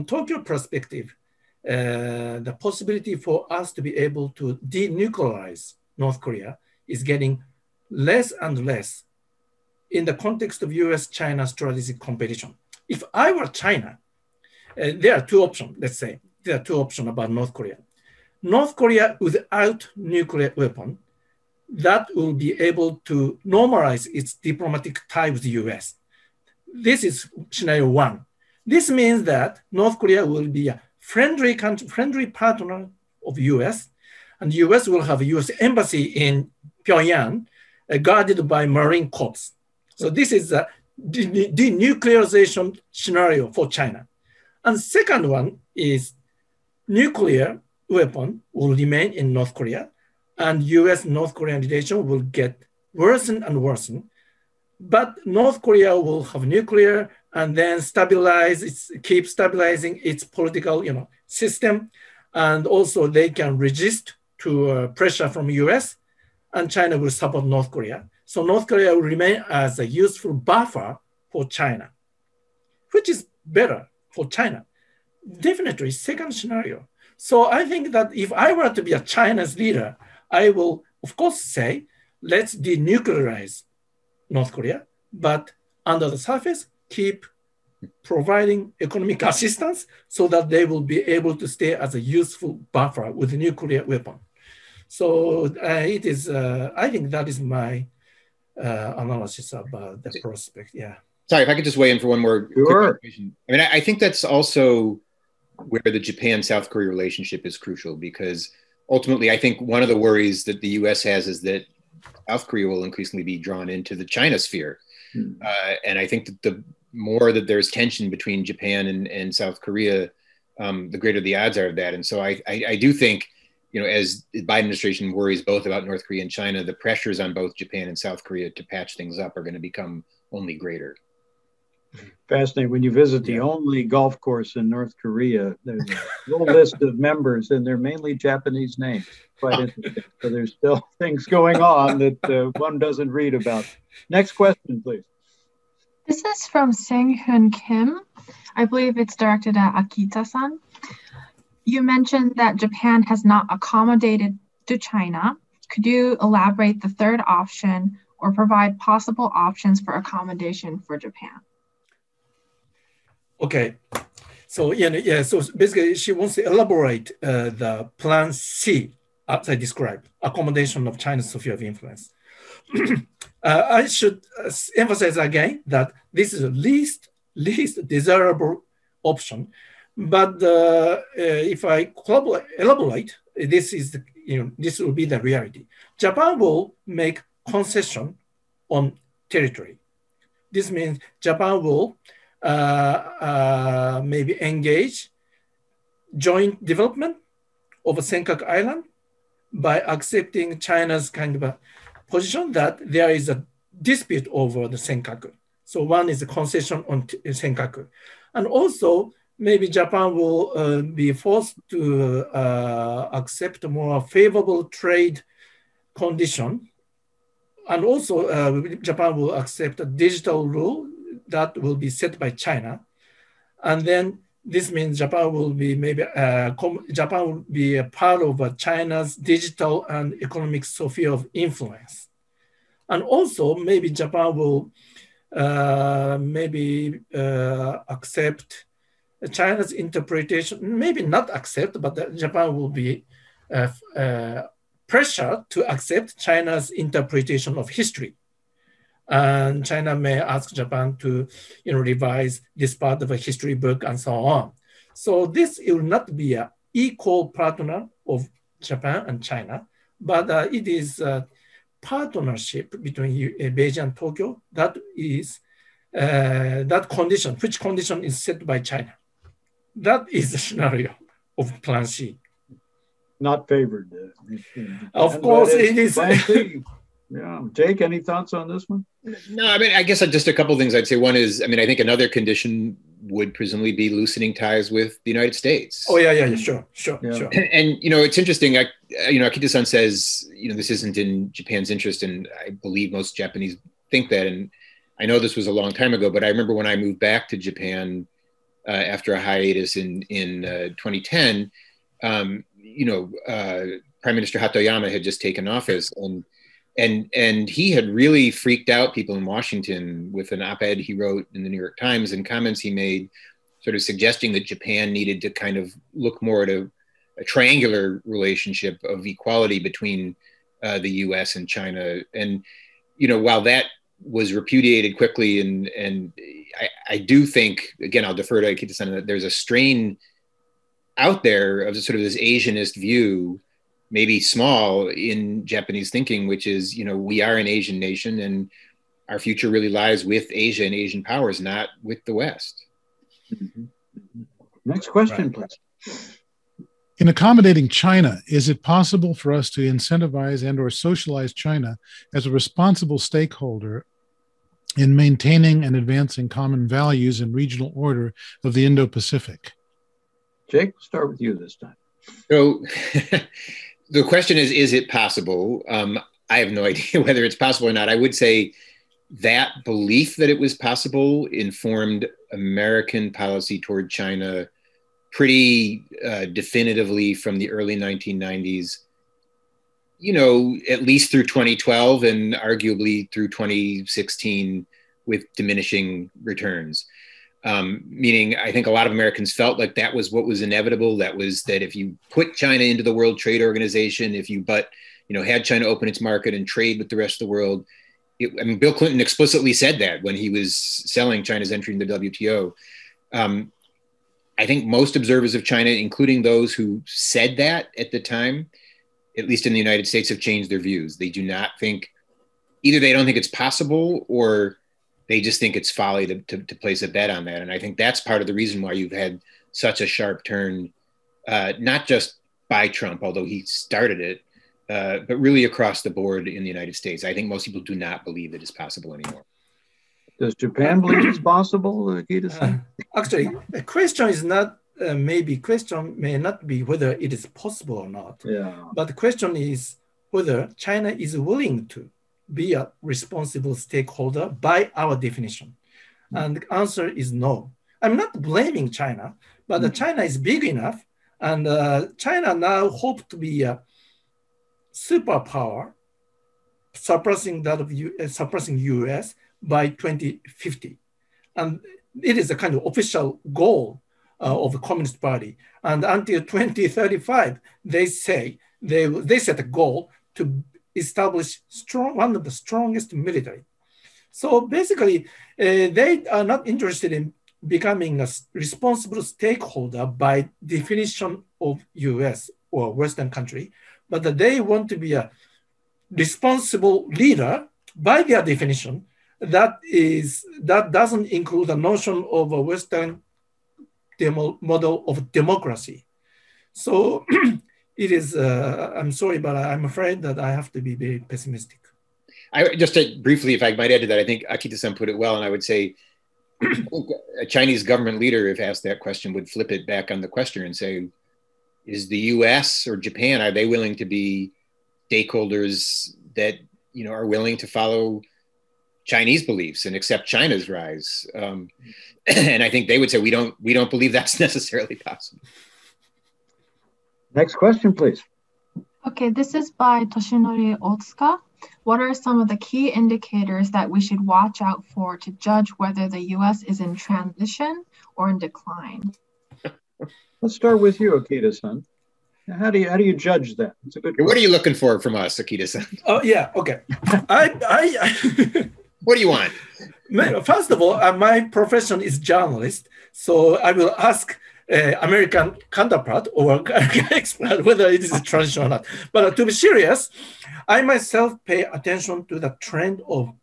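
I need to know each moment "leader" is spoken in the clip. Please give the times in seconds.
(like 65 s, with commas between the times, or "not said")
79 s, 486 s, 508 s.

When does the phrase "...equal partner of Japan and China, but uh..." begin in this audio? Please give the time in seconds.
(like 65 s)
256 s.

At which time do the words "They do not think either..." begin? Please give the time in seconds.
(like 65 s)
410 s.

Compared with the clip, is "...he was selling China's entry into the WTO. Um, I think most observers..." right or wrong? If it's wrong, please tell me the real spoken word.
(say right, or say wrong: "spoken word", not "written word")
right.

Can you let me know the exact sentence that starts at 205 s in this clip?
So one is a concession on Senkaku.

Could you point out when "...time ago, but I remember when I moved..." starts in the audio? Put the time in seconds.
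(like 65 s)
295 s.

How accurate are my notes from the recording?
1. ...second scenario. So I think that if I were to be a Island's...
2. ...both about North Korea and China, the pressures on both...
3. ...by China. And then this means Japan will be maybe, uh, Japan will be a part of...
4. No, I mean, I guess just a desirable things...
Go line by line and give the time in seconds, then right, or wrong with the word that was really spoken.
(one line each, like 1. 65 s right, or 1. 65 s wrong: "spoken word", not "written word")
1. 75 s wrong: "China", not "Island"
2. 125 s right
3. 222 s right
4. 279 s wrong: "couple", not "desirable".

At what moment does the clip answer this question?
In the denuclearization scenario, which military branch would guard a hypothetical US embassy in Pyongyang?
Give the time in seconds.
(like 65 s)
38 s.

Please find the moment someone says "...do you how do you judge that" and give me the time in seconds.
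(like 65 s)
542 s.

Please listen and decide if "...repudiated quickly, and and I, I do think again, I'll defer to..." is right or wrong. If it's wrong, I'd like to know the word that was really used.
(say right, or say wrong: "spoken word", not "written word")
right.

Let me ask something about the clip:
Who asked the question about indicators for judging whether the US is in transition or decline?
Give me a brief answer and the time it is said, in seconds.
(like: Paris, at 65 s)
Toshinori Otsuka, at 529 s.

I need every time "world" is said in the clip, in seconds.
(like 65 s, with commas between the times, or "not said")
392 s, 397 s.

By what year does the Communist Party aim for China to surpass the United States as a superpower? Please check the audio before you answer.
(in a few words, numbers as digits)
2050.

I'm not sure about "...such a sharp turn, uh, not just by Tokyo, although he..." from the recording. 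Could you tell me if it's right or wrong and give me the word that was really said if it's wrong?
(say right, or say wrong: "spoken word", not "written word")
wrong: "Trump", not "Tokyo".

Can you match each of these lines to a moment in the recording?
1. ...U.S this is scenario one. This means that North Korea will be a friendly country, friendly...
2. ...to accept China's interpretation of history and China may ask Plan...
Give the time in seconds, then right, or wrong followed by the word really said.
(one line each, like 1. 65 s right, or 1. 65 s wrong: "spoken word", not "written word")
1. 25 s right
2. 245 s wrong: "Japan", not "Plan".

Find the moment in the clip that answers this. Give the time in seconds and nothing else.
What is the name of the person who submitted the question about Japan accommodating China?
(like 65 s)
146 s.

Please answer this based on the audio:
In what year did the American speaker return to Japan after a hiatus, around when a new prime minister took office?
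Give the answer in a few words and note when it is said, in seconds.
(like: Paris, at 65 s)
2010, at 300 s.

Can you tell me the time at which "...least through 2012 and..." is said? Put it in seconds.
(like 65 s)
380 s.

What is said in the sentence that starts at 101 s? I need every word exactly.
Sorry, if I could just weigh in for one more.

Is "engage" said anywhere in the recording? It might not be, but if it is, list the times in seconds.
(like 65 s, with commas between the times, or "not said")
194 s.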